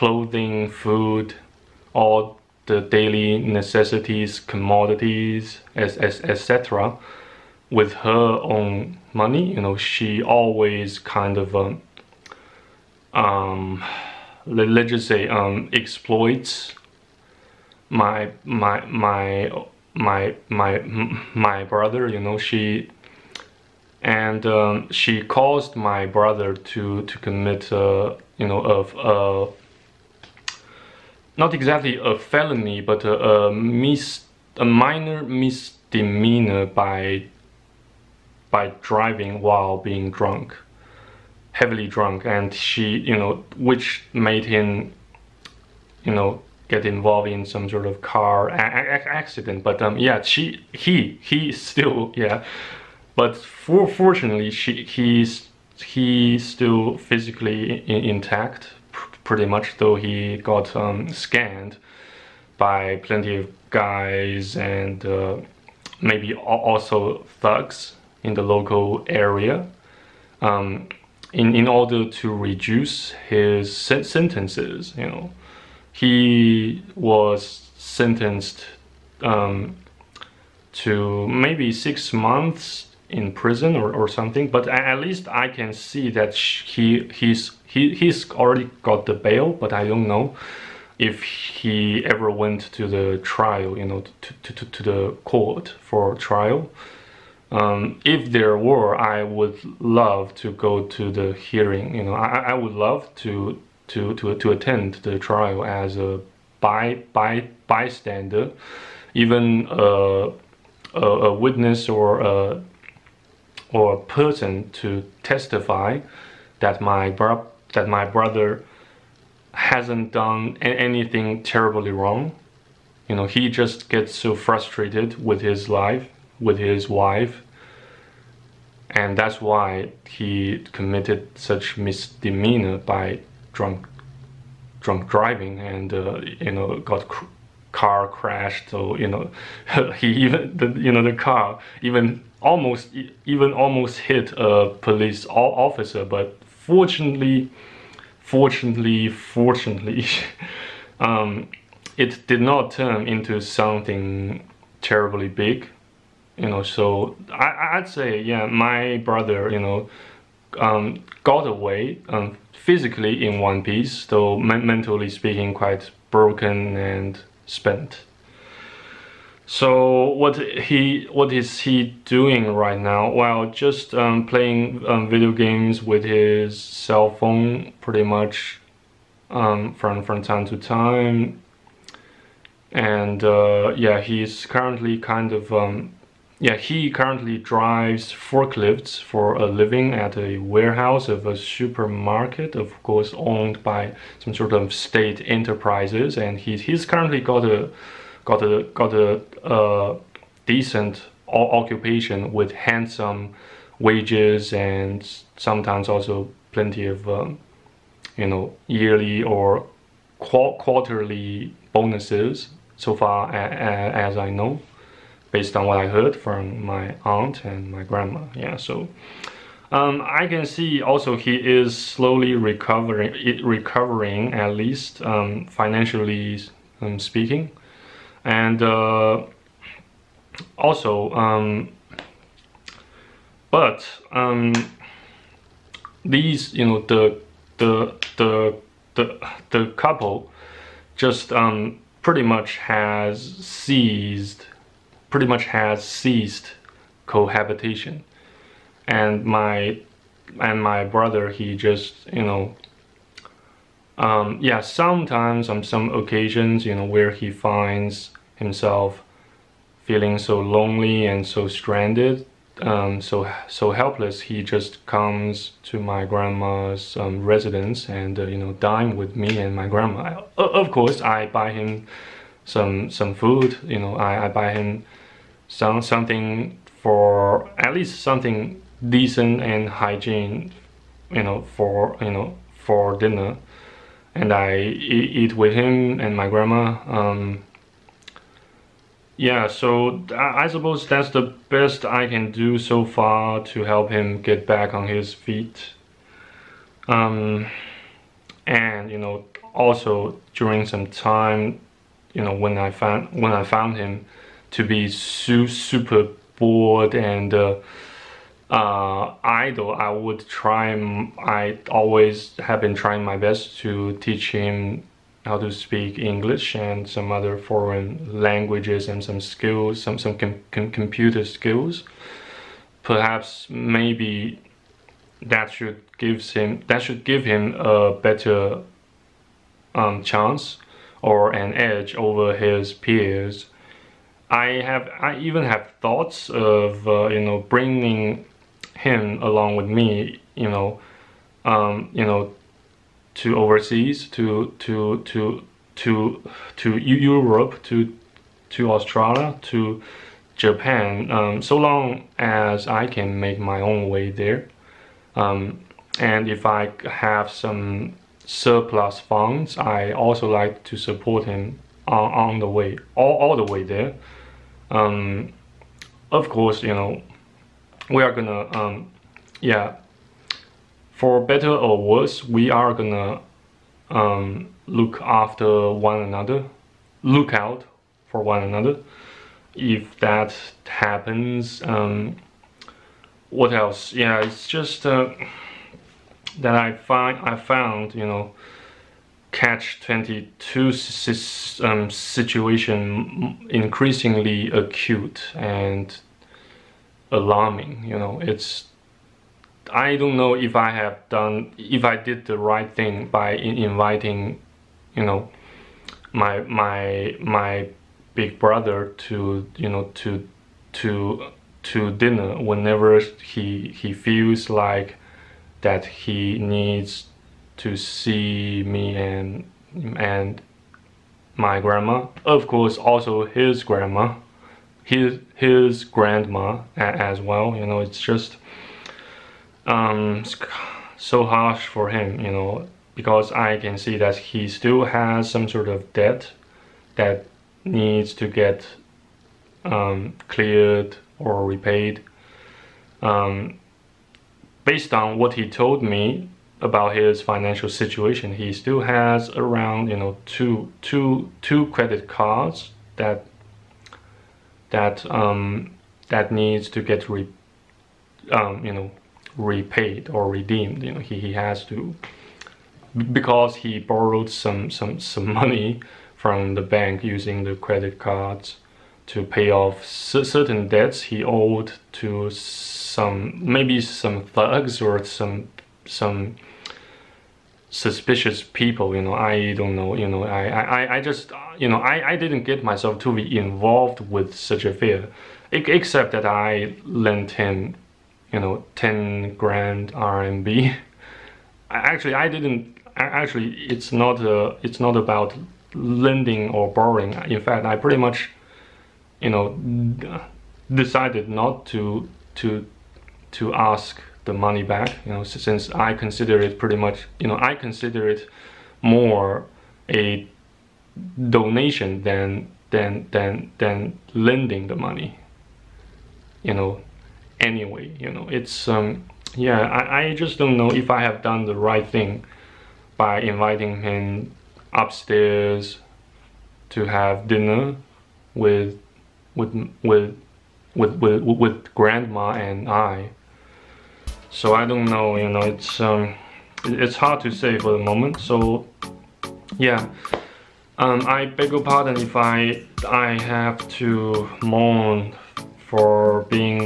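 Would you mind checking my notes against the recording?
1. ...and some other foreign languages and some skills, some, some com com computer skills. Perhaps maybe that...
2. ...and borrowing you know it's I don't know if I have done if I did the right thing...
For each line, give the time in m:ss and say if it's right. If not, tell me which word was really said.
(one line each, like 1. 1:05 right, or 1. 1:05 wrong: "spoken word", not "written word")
1. 5:16 right
2. 6:35 wrong: "alarming", not "borrowing".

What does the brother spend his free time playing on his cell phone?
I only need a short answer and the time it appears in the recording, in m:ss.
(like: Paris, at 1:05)
video games, at 2:55.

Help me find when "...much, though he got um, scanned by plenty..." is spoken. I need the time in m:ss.
0:59.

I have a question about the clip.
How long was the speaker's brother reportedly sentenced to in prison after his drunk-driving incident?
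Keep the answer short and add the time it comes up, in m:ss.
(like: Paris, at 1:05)
6 months, at 1:21.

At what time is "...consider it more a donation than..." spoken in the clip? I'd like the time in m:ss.
8:27.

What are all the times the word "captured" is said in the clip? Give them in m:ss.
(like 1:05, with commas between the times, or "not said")
not said.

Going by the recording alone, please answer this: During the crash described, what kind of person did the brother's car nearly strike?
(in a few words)
police officer.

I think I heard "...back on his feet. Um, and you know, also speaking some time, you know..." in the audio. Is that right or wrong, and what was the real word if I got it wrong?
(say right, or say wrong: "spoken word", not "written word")
wrong: "during", not "speaking".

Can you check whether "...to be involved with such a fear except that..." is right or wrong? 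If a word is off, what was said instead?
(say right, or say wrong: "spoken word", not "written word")
right.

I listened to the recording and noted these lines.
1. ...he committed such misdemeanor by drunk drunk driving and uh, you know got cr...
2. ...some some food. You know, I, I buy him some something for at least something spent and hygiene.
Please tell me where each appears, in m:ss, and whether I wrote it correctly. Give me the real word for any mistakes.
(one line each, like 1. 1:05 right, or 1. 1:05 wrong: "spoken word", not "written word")
1. 2:10 right
2. 4:32 wrong: "decent", not "spent".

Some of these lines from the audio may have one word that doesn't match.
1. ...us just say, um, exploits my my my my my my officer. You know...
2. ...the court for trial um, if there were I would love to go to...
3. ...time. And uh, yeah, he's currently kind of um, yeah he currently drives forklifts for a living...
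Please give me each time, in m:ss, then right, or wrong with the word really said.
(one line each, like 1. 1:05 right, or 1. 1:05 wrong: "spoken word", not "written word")
1. 0:14 wrong: "brother", not "officer"
2. 1:34 right
3. 3:00 right.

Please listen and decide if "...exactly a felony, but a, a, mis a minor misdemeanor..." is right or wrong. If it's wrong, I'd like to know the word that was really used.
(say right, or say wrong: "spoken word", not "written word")
right.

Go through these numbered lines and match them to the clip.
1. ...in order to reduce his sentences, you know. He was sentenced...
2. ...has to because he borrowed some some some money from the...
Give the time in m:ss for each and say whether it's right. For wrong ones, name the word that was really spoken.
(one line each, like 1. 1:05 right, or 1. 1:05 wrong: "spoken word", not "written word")
1. 1:11 right
2. 7:41 right.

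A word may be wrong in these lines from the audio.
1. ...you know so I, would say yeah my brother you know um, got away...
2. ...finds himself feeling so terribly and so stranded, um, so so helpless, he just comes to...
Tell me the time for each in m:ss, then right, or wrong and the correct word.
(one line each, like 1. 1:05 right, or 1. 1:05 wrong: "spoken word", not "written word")
1. 2:36 right
2. 4:17 wrong: "lonely", not "terribly".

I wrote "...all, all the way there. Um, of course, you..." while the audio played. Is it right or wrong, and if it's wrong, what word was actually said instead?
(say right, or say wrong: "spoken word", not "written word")
right.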